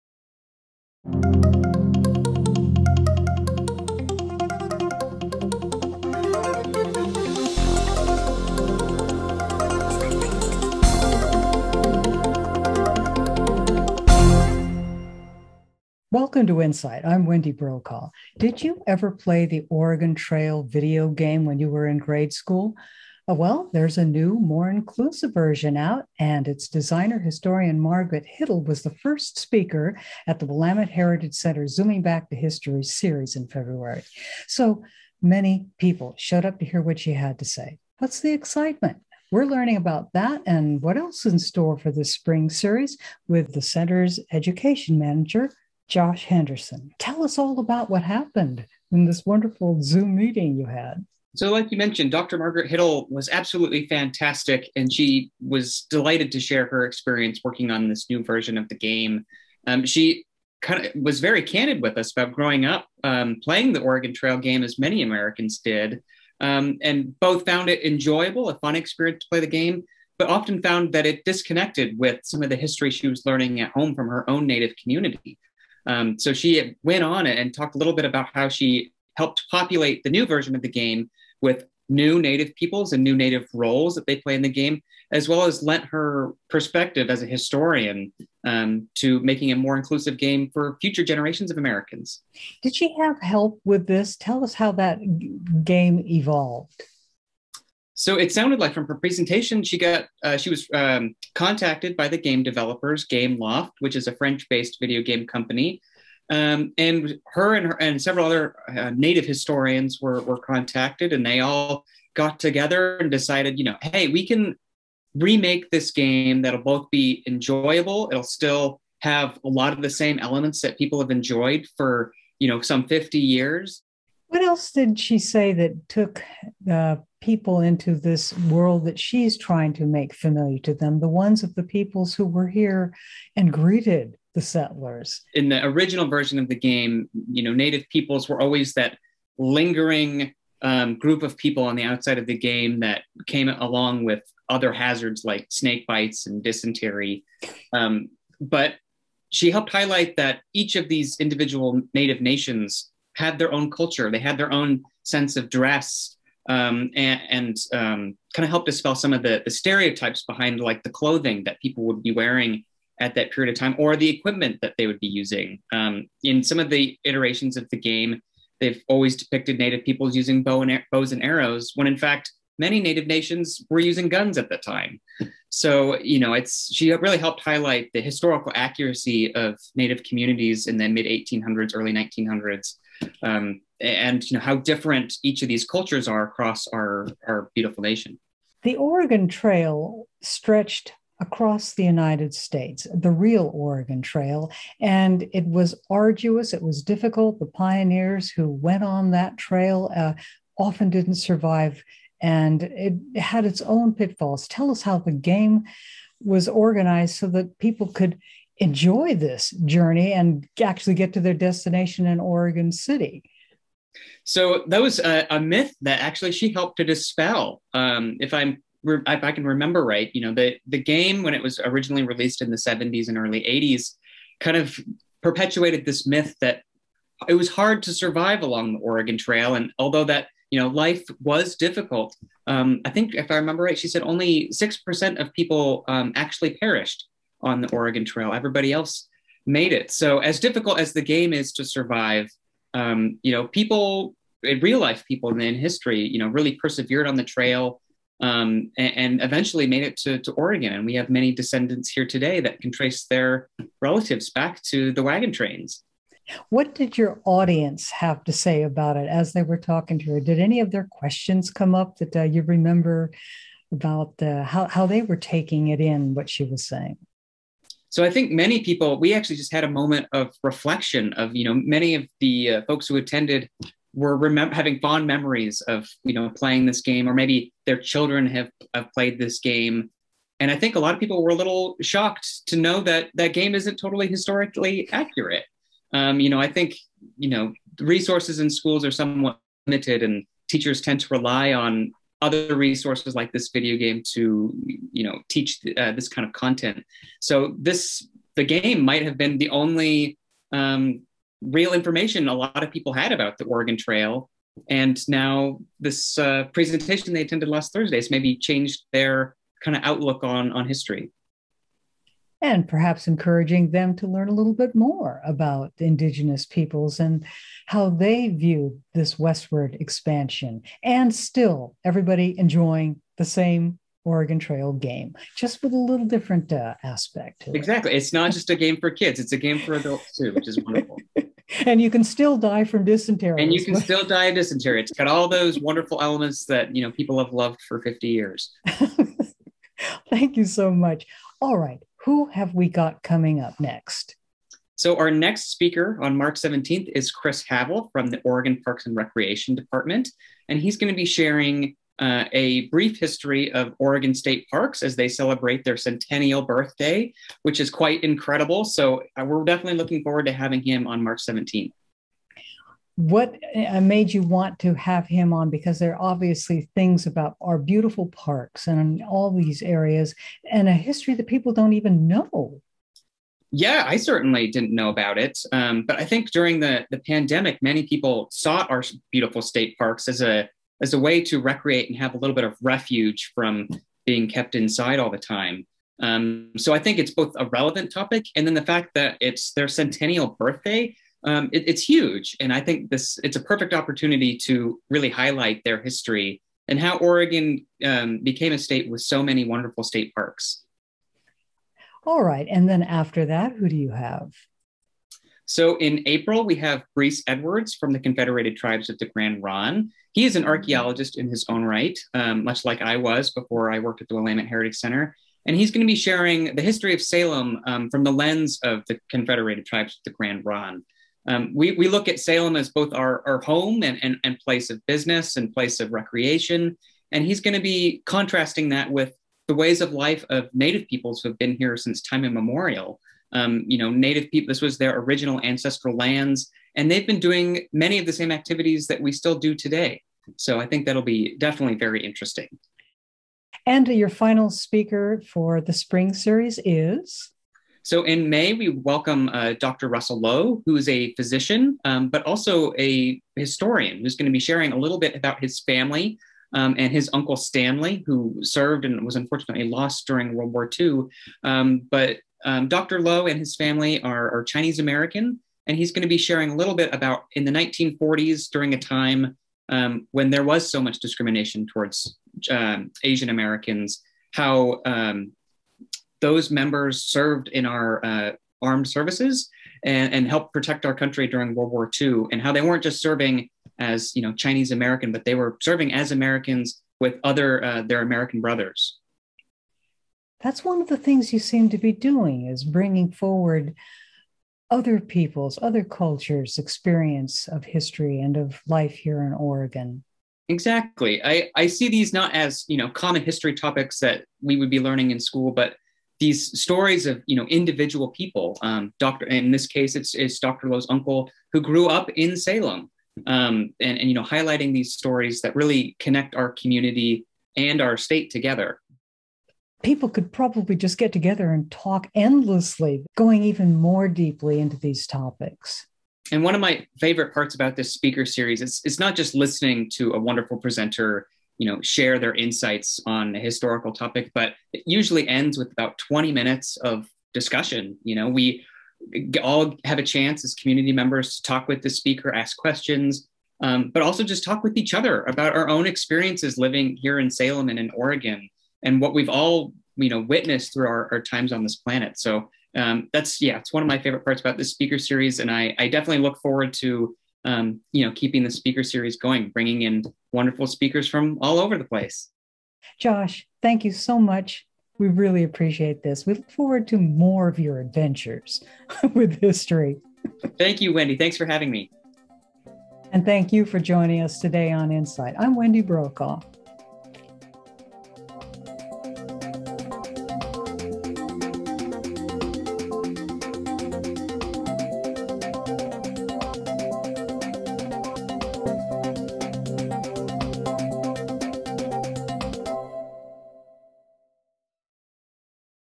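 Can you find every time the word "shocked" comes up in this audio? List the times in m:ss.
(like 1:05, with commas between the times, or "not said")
4:41.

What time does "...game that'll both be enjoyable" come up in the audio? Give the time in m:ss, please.
1:55.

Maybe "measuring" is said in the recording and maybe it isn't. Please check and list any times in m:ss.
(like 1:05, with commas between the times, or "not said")
not said.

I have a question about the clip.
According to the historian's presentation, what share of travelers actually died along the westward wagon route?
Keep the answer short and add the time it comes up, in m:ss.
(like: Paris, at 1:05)
6%, at 3:54.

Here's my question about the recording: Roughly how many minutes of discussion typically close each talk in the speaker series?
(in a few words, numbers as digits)
20.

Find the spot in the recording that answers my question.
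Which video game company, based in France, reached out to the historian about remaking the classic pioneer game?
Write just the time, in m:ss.
1:43.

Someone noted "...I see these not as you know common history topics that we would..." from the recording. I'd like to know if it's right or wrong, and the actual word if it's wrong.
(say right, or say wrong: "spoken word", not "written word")
right.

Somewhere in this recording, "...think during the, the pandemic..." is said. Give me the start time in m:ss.
6:16.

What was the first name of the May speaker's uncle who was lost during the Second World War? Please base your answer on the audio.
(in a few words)
Stanley.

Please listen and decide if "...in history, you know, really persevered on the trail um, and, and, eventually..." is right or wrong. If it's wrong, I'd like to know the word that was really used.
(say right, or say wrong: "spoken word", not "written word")
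right.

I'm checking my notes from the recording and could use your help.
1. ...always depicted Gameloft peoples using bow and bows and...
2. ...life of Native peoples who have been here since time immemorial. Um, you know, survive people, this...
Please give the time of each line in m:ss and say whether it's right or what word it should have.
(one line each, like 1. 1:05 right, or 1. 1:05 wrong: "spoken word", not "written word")
1. 2:48 wrong: "Native", not "Gameloft"
2. 7:09 wrong: "native", not "survive".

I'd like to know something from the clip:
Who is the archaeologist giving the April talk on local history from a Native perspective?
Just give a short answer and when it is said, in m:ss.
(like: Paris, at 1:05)
Briece Edwards, at 6:46.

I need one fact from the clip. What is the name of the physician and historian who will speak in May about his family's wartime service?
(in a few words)
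Dr. Russell Lowe.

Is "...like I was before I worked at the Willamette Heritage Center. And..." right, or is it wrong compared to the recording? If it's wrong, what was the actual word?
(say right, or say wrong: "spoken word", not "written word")
right.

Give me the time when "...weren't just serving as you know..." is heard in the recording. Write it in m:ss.
8:02.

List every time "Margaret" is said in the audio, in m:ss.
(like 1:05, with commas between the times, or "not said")
0:27, 0:52.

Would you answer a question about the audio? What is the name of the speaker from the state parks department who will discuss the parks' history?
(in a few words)
Chris Havel.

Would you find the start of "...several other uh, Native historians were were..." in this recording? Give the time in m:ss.
1:48.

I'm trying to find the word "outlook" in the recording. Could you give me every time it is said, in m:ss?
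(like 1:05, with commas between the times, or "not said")
5:09.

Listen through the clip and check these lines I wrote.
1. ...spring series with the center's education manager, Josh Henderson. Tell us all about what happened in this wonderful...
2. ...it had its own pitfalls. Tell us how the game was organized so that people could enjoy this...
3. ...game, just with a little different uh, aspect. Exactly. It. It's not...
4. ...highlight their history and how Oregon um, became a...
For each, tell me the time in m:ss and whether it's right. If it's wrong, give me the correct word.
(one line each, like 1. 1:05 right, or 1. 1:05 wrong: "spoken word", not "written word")
1. 0:42 right
2. 3:22 right
3. 5:24 right
4. 6:35 right.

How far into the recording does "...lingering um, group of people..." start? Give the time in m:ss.
2:19.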